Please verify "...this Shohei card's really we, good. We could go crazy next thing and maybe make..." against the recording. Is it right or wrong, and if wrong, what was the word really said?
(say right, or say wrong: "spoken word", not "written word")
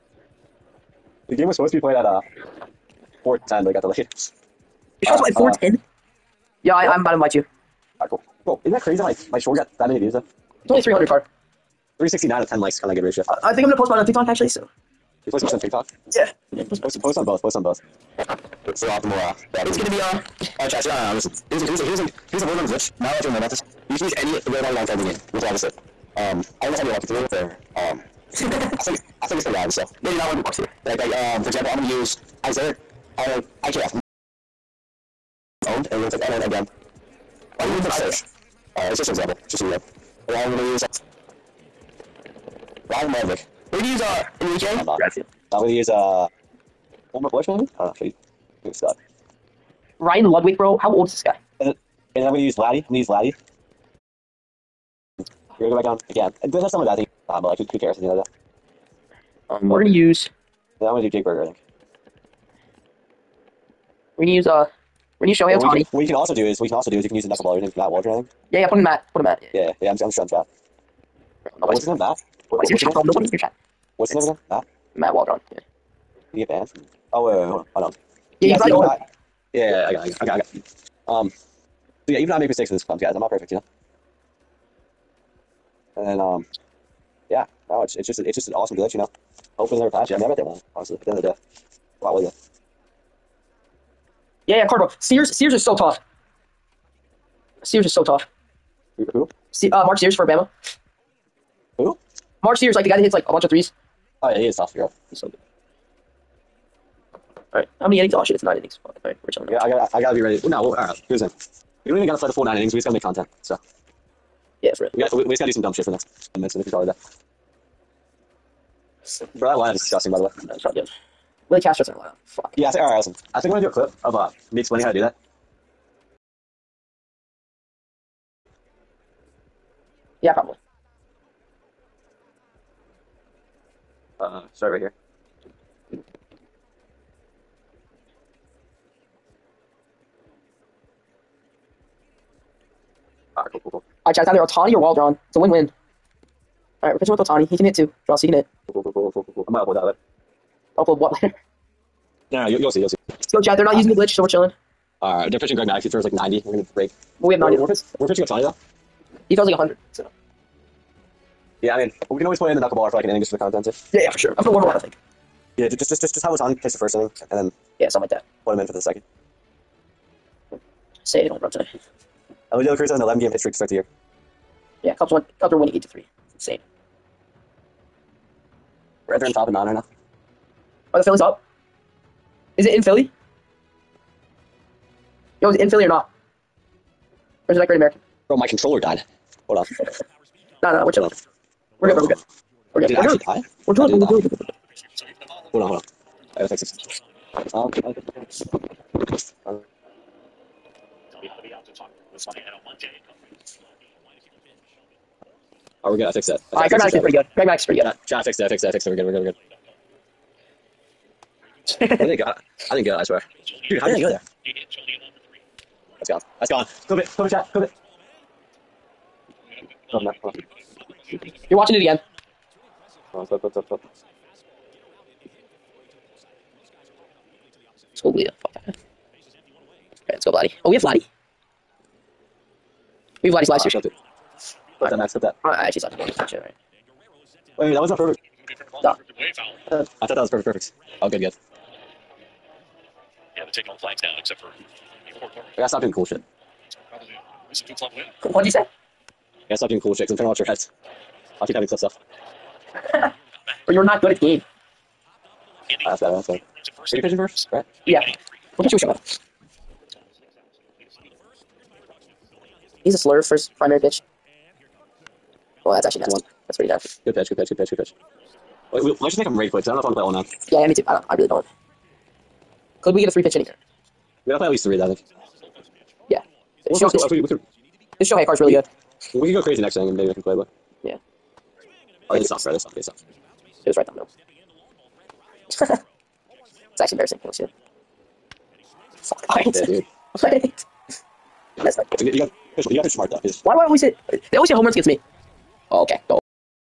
right.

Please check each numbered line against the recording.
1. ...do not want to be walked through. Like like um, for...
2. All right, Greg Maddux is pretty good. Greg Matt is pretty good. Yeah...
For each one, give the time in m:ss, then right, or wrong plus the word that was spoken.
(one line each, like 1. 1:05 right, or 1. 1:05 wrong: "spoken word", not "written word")
1. 0:30 right
2. 3:26 wrong: "Maddux", not "Matt".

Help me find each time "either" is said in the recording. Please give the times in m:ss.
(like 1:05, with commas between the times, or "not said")
2:24.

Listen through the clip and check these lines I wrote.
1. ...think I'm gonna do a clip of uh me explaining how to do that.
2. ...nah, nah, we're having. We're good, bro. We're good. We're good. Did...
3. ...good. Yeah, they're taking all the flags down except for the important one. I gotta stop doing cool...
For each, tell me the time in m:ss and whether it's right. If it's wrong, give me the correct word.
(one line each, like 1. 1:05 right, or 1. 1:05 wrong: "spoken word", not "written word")
1. 2:03 right
2. 3:10 wrong: "chilling", not "having"
3. 4:01 right.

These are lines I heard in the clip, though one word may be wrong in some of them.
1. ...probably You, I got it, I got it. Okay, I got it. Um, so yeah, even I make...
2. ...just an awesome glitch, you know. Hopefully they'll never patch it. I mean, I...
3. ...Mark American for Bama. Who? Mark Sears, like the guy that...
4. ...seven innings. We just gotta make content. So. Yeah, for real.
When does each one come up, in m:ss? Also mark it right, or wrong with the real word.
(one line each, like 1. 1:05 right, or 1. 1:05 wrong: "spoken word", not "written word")
1. 1:18 wrong: "Yeah", not "You"
2. 1:28 right
3. 1:39 wrong: "Sears", not "American"
4. 1:52 wrong: "nine", not "seven".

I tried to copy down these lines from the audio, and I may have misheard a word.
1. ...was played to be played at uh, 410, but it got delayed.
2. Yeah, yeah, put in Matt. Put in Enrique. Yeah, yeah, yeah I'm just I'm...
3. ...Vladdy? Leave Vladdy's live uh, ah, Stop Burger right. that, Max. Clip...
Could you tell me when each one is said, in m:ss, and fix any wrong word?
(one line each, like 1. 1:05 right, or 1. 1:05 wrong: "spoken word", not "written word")
1. 0:01 wrong: "supposed", not "played"
2. 1:08 wrong: "Matt", not "Enrique"
3. 3:50 wrong: "Clip", not "Burger".